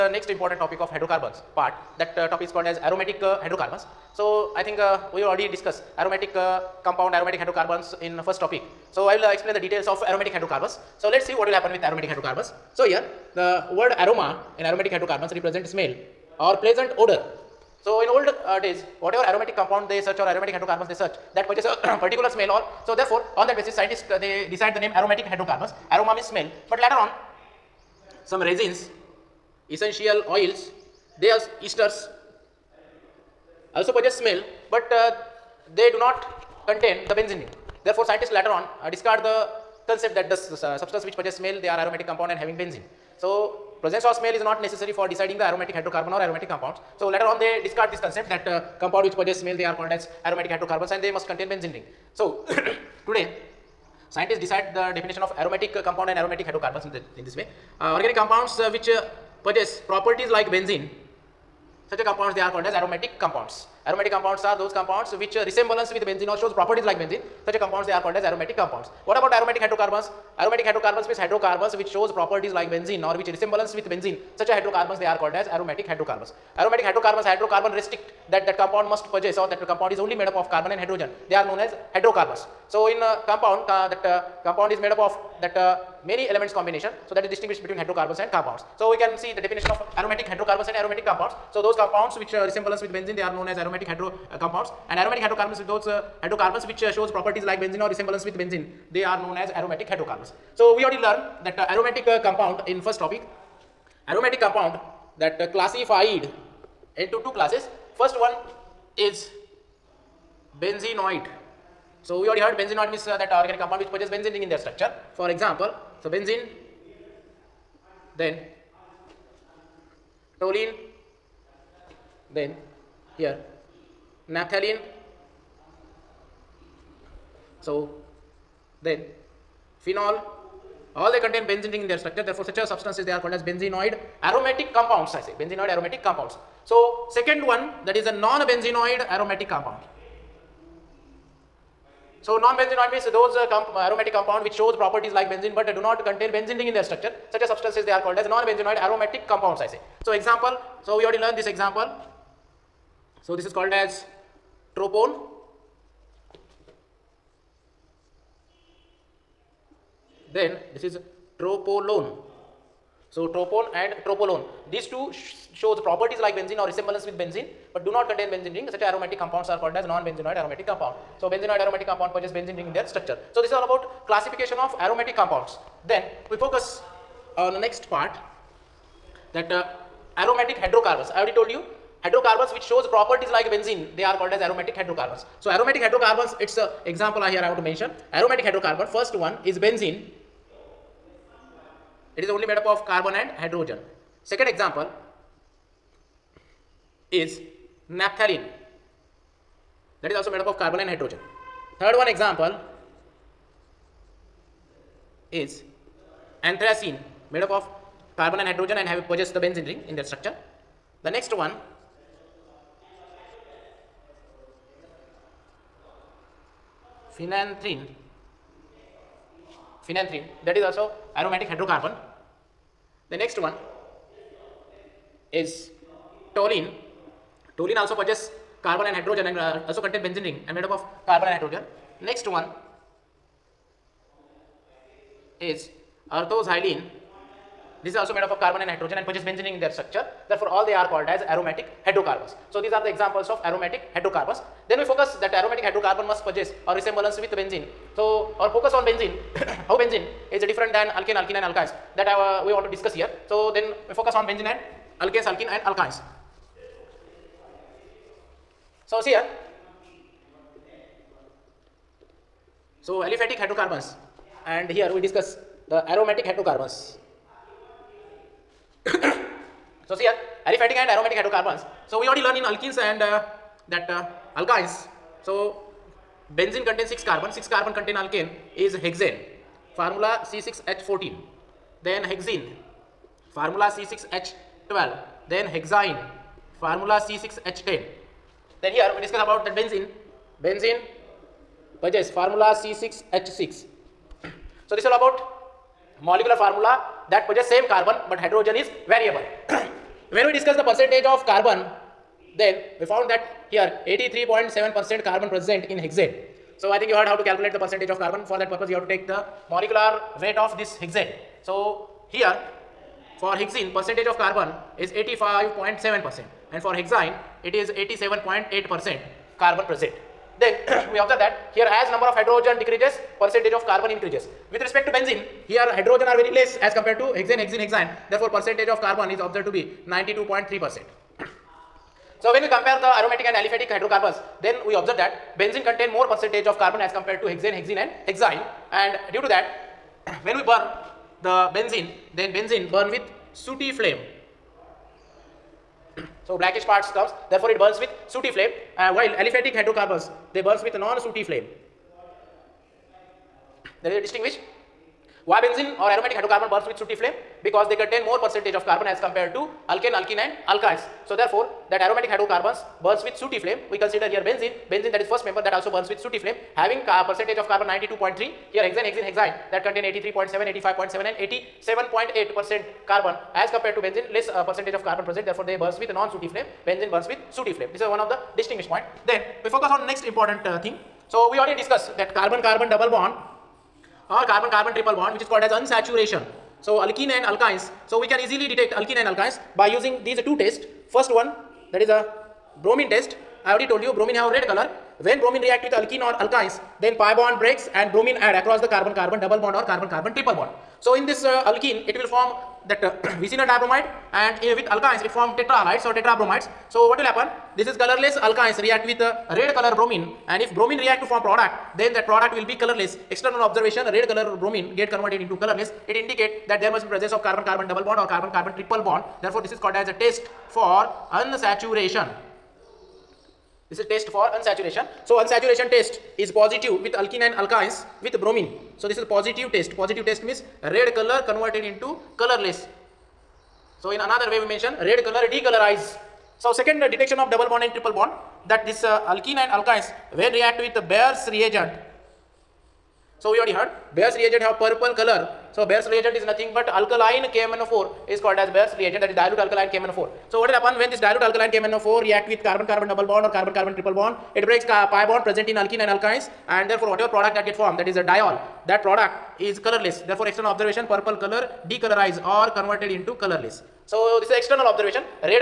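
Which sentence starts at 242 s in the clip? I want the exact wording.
So, these are the examples of aromatic hydrocarbons.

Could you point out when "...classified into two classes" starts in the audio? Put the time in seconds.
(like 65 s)
105 s.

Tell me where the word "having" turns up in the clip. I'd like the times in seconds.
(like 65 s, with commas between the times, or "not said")
42 s, 366 s.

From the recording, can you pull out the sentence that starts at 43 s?
So, Presence of smell is not necessary for deciding the aromatic hydrocarbon or aromatic compounds.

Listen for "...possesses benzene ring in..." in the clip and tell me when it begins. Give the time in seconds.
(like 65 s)
113 s.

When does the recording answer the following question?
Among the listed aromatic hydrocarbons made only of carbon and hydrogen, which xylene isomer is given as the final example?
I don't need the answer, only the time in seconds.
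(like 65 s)
236 s.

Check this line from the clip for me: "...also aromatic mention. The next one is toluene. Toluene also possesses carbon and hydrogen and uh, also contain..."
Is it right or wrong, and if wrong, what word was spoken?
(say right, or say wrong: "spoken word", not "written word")
wrong: "hydrocarbon", not "mention".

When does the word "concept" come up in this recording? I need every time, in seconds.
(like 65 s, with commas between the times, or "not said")
39 s, 47 s.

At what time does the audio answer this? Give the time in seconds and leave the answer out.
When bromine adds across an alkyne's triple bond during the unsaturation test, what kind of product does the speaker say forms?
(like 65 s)
405 s.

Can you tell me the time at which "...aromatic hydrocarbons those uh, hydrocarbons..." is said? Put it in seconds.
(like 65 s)
94 s.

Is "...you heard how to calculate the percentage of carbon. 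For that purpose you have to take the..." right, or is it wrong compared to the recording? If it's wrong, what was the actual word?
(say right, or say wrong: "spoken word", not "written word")
right.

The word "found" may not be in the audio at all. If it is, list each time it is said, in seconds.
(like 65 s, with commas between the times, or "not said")
302 s.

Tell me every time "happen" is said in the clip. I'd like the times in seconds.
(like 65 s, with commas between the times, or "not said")
11 s, 407 s, 450 s.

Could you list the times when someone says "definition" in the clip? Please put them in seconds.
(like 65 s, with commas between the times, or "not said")
54 s, 89 s.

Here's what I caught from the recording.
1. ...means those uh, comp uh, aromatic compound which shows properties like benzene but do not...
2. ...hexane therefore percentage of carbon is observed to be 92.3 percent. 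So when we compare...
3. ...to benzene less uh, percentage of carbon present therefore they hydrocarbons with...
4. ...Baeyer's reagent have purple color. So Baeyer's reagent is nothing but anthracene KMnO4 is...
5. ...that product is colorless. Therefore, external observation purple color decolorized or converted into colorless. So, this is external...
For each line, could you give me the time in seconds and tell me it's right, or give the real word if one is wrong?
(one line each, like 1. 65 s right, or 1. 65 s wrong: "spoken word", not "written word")
1. 142 s right
2. 327 s right
3. 373 s wrong: "burns", not "hydrocarbons"
4. 443 s wrong: "alkaline", not "anthracene"
5. 458 s right.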